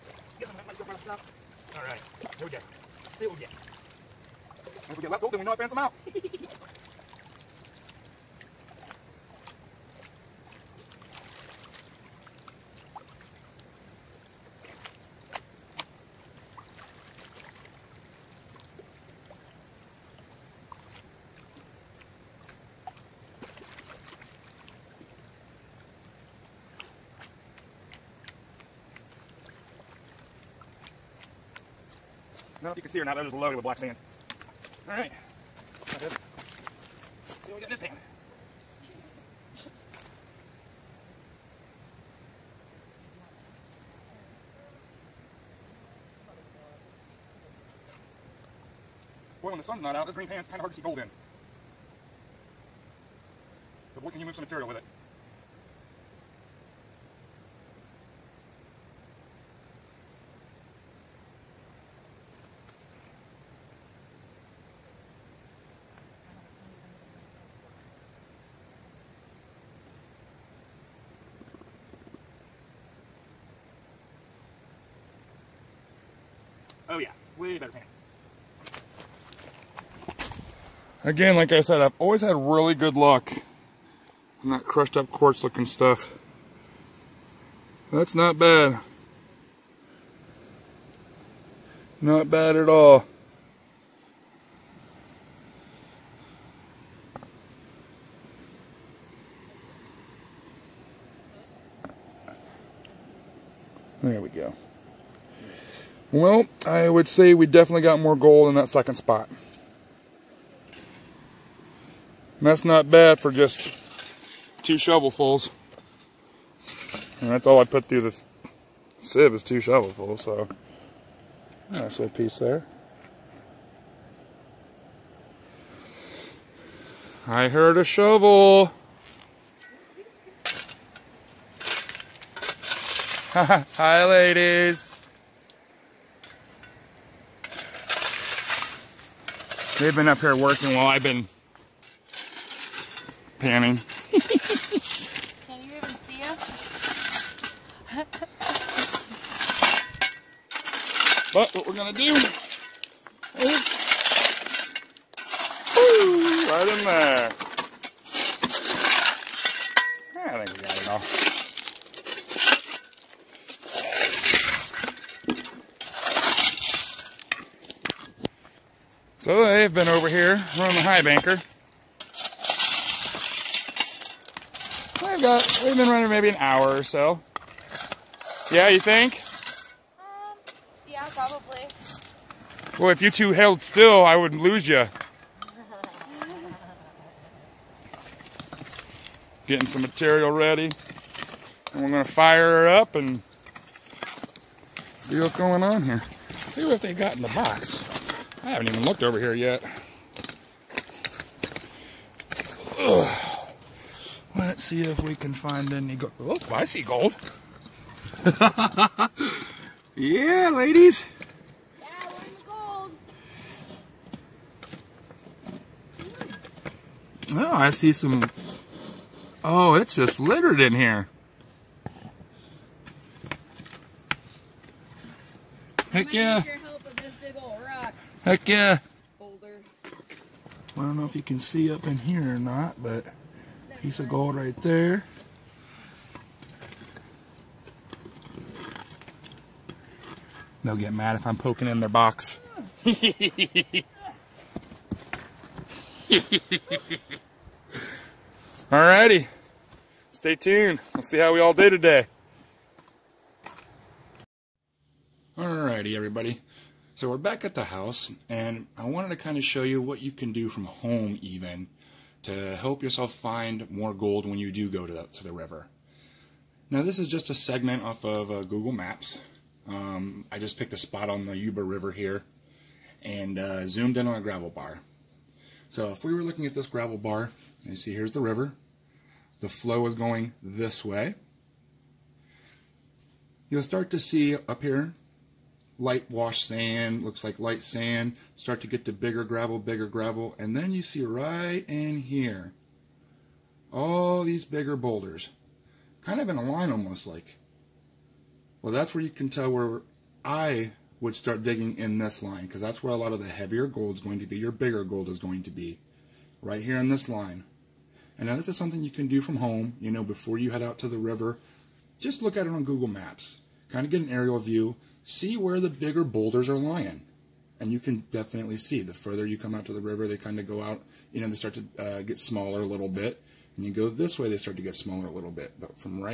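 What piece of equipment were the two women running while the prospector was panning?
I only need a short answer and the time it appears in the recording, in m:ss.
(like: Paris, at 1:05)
High banker, at 2:50.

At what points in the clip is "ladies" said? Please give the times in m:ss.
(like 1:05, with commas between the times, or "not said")
2:14, 3:30.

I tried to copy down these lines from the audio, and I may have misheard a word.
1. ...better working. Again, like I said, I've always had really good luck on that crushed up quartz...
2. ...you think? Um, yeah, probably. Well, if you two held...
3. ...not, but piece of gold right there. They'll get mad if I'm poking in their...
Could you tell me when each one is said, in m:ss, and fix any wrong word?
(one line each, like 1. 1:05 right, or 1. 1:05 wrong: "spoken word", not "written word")
1. 1:17 wrong: "painting", not "working"
2. 2:58 right
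3. 3:52 right.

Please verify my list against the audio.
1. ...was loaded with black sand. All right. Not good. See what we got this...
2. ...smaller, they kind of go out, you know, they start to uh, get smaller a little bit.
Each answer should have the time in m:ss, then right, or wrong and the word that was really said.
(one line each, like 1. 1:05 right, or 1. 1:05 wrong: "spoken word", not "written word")
1. 0:33 right
2. 5:19 wrong: "river", not "smaller".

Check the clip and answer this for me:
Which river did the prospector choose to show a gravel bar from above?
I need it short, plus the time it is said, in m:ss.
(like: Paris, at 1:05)
Yuba River, at 4:31.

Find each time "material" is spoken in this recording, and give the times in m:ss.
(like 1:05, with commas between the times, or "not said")
0:54, 3:09.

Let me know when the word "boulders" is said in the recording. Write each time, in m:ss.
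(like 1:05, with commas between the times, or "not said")
3:49, 4:54, 5:16.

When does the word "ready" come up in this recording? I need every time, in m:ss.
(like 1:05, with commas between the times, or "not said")
3:10.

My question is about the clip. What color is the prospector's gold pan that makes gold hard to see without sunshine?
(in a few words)
Green.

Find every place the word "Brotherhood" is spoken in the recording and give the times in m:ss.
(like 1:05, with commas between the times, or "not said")
not said.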